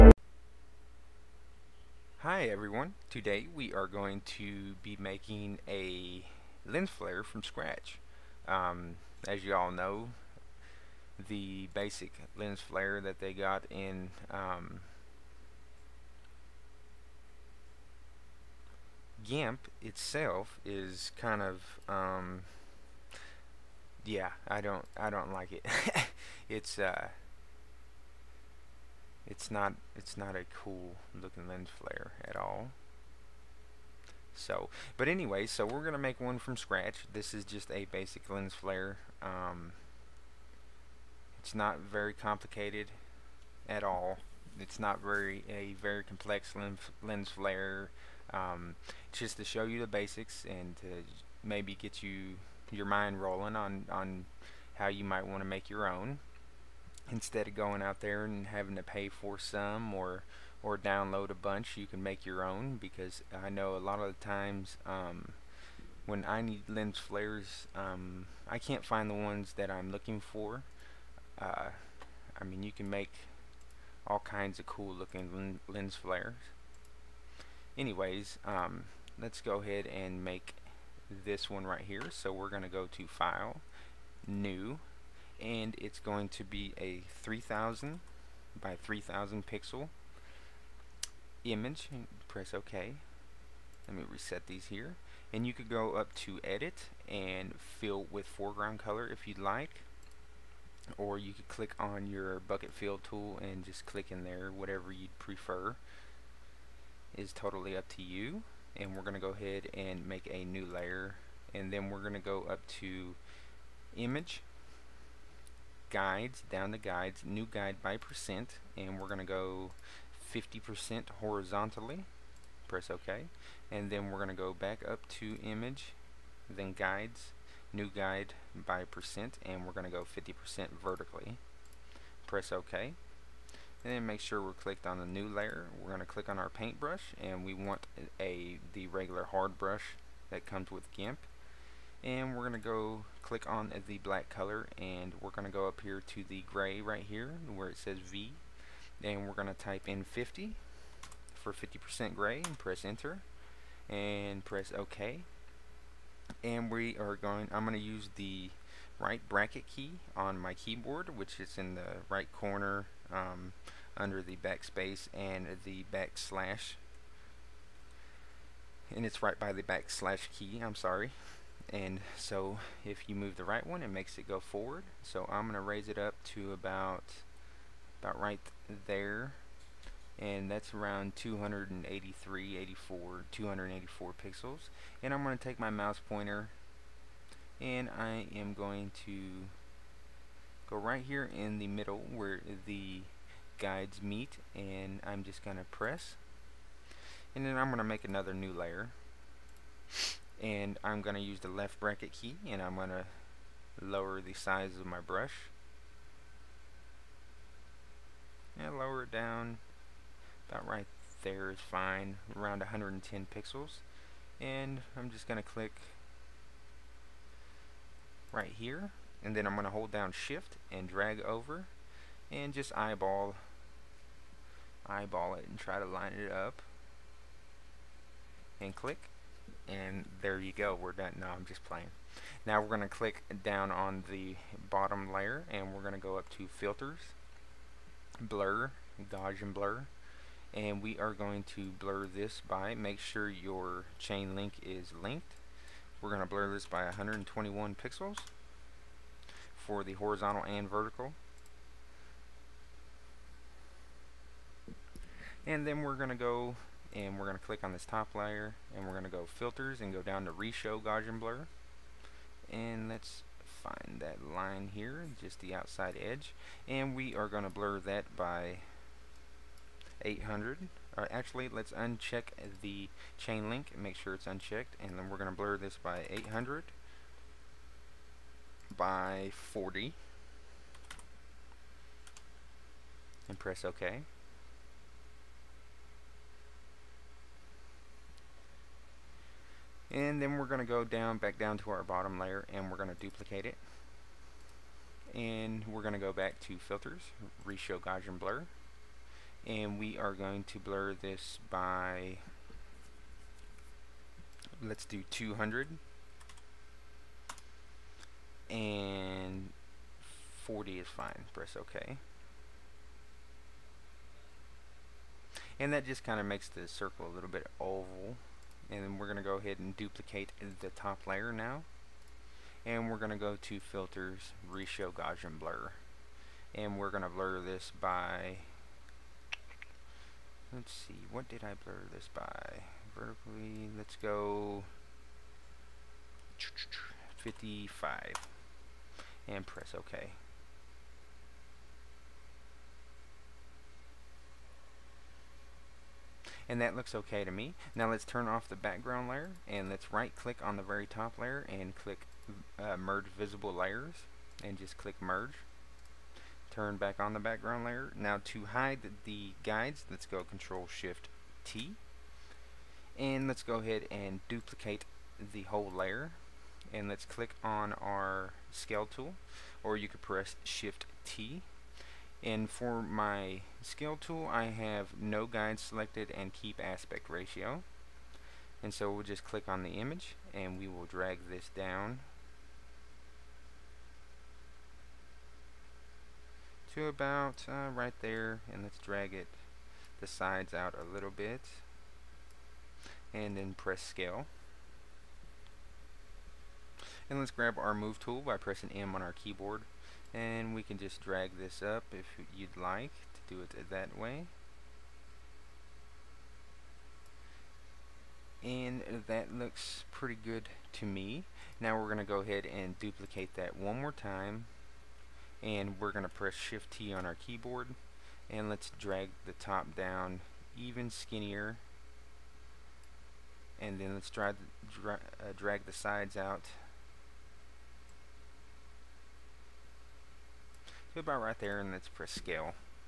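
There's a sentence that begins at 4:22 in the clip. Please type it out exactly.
And let's find that line here, just the outside edge, and we are going to blur that by 800.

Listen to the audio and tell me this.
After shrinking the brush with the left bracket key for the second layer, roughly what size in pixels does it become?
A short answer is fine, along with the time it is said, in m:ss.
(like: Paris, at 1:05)
110, at 3:32.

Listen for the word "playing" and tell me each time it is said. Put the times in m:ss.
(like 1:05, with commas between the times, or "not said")
3:51.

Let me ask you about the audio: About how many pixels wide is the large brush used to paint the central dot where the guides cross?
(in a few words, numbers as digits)
284.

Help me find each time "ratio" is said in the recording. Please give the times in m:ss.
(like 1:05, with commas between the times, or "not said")
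6:17.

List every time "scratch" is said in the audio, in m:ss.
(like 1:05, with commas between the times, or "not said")
0:07, 0:36.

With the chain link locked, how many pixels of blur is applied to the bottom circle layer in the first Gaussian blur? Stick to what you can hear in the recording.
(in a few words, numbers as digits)
121.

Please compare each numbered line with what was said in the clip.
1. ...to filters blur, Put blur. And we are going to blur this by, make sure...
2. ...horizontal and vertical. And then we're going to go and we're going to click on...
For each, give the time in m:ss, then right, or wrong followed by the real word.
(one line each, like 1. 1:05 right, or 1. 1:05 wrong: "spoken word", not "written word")
1. 3:56 wrong: "Gaussian", not "Put"
2. 4:09 right.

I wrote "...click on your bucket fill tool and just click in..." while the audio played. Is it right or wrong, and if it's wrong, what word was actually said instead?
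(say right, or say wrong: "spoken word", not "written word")
right.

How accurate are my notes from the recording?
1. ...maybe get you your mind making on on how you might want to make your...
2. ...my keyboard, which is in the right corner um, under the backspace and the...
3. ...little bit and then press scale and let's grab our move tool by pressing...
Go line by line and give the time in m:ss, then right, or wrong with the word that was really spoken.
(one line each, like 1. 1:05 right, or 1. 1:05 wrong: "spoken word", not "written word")
1. 0:51 wrong: "rolling", not "making"
2. 2:40 right
3. 6:30 right.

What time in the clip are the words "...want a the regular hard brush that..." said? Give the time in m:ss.
2:17.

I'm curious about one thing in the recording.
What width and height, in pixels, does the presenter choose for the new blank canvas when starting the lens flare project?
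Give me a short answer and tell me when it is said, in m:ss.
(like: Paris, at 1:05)
3000 by 3000, at 1:27.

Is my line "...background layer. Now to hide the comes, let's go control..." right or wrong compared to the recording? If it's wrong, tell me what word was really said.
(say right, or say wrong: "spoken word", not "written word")
wrong: "guides", not "comes".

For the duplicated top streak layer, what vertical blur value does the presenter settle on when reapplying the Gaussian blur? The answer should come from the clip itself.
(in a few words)
55.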